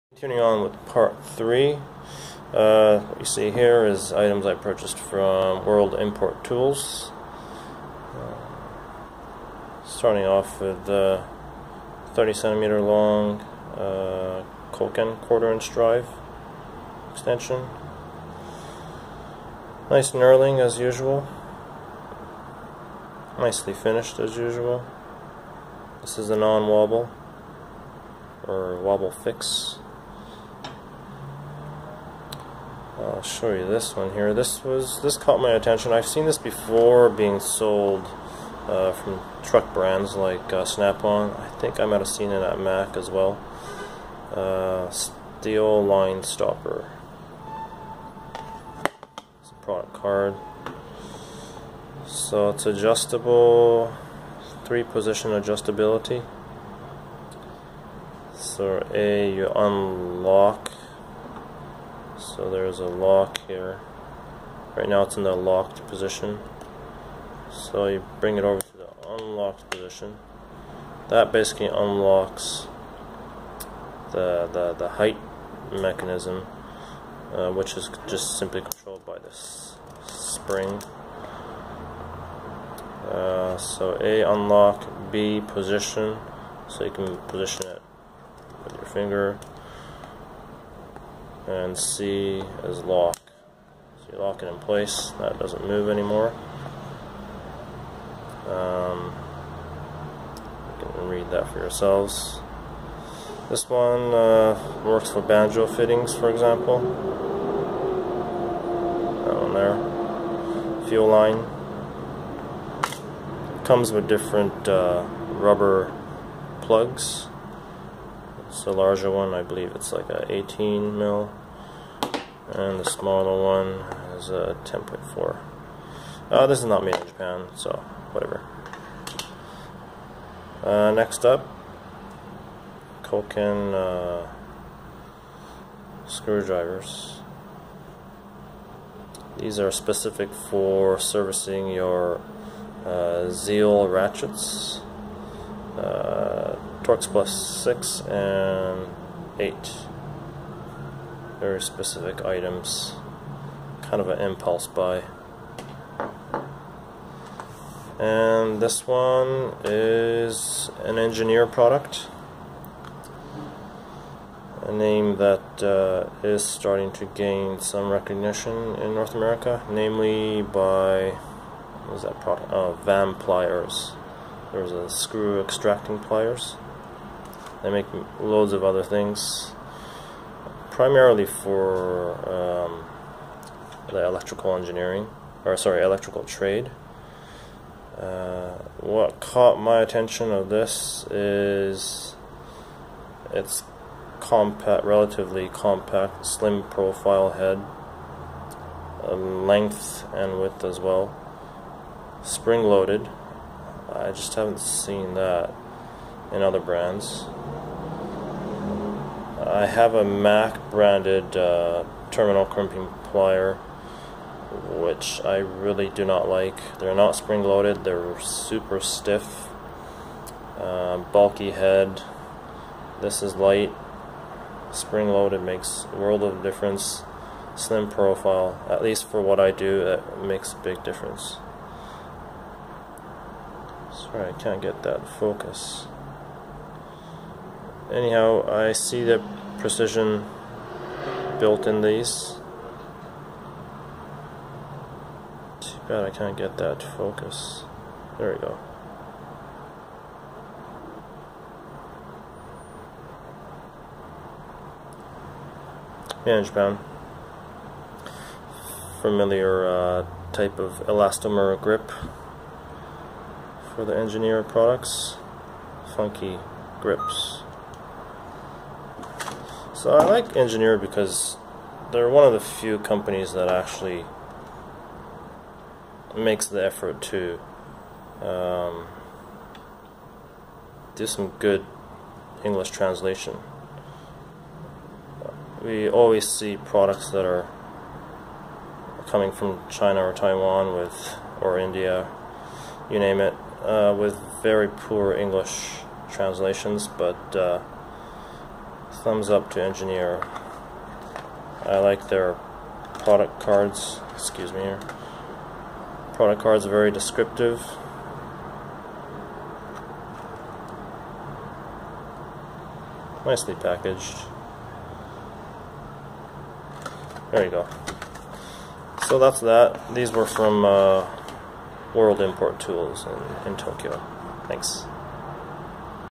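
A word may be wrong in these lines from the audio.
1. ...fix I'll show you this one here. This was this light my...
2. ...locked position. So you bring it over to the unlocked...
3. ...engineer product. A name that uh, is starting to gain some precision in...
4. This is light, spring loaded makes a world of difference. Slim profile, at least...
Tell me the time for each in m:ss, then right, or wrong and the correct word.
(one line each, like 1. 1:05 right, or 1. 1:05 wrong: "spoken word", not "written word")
1. 0:29 wrong: "caught", not "light"
2. 1:05 right
3. 2:40 wrong: "recognition", not "precision"
4. 3:43 right.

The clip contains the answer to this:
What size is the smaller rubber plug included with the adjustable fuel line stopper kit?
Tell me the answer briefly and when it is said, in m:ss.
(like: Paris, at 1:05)
10.4, at 2:04.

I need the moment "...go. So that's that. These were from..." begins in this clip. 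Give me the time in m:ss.
5:17.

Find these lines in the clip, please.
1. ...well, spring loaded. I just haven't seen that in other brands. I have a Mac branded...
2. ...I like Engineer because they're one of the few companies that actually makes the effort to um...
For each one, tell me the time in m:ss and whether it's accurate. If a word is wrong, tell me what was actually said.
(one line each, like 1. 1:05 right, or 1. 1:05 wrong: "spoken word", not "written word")
1. 3:20 right
2. 4:29 right.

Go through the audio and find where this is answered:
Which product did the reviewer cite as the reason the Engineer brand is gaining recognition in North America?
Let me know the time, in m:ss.
2:52.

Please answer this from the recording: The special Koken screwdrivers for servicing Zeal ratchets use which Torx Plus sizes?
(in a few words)
6 and 8.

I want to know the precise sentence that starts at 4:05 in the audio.
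Too bad I can't get that focus.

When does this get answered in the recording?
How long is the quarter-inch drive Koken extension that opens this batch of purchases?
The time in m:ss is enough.
0:12.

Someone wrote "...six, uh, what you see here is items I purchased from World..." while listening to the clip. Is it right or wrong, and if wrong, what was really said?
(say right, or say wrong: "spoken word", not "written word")
wrong: "three", not "six".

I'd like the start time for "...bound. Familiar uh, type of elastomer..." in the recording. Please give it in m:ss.
4:16.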